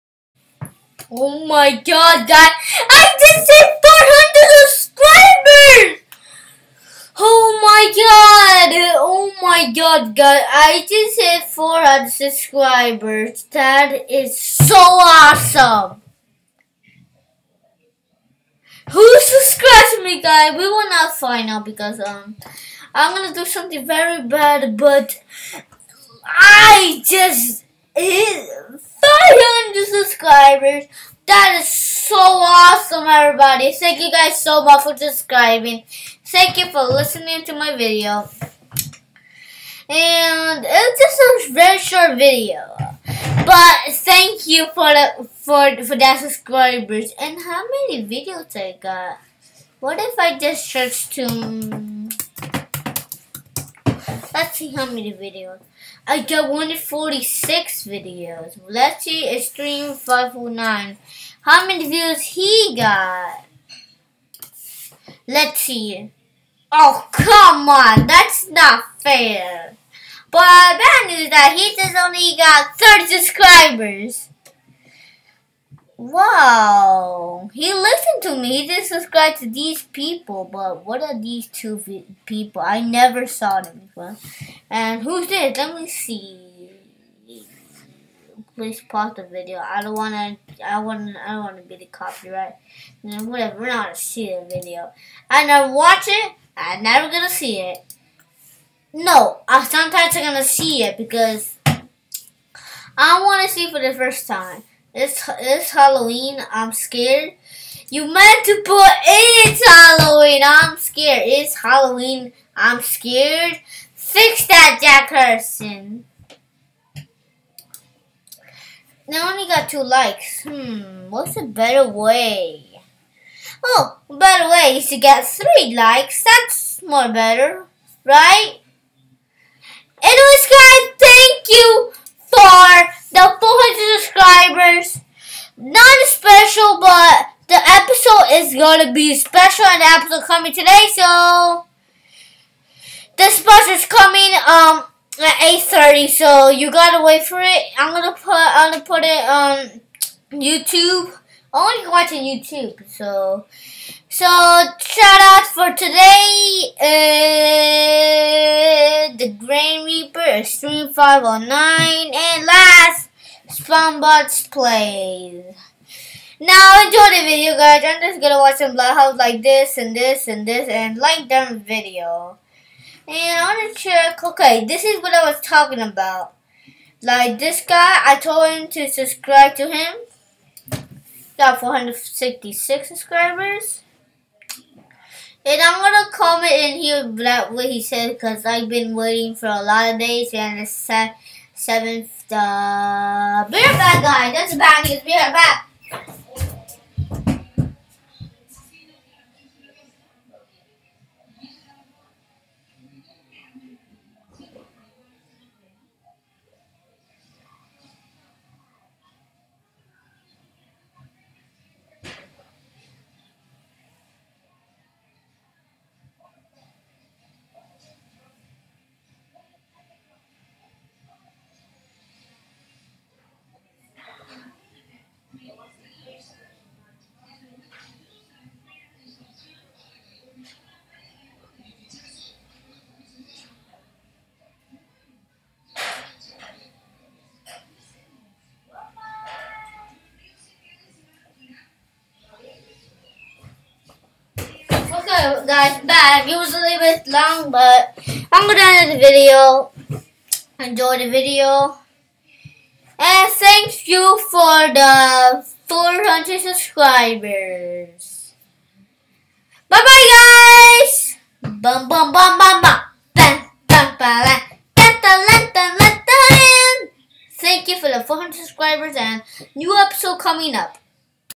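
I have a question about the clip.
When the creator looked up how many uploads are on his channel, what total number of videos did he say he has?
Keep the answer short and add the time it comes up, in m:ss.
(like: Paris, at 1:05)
146, at 0:56.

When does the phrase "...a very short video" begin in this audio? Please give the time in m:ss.
0:41.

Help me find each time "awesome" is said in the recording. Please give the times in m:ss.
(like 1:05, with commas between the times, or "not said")
0:14, 0:32.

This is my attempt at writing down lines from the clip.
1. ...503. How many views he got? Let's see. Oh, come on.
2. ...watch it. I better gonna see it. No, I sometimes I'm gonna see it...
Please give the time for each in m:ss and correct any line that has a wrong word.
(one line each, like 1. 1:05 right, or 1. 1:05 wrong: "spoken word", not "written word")
1. 0:59 wrong: "509", not "503"
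2. 1:35 wrong: "never", not "better".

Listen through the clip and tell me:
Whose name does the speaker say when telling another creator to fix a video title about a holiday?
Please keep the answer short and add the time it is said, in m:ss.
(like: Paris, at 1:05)
Jack Harrison, at 1:54.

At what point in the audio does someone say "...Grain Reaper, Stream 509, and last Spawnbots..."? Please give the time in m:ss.
2:39.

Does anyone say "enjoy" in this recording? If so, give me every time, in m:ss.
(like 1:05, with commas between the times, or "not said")
2:46, 4:10.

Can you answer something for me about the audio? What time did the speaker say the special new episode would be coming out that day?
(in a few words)
8:30.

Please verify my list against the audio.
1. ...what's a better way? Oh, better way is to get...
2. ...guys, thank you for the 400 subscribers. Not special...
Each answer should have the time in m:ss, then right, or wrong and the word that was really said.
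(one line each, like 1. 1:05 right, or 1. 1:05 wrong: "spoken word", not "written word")
1. 2:01 right
2. 2:10 right.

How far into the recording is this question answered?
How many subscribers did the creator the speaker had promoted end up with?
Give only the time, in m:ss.
3:01.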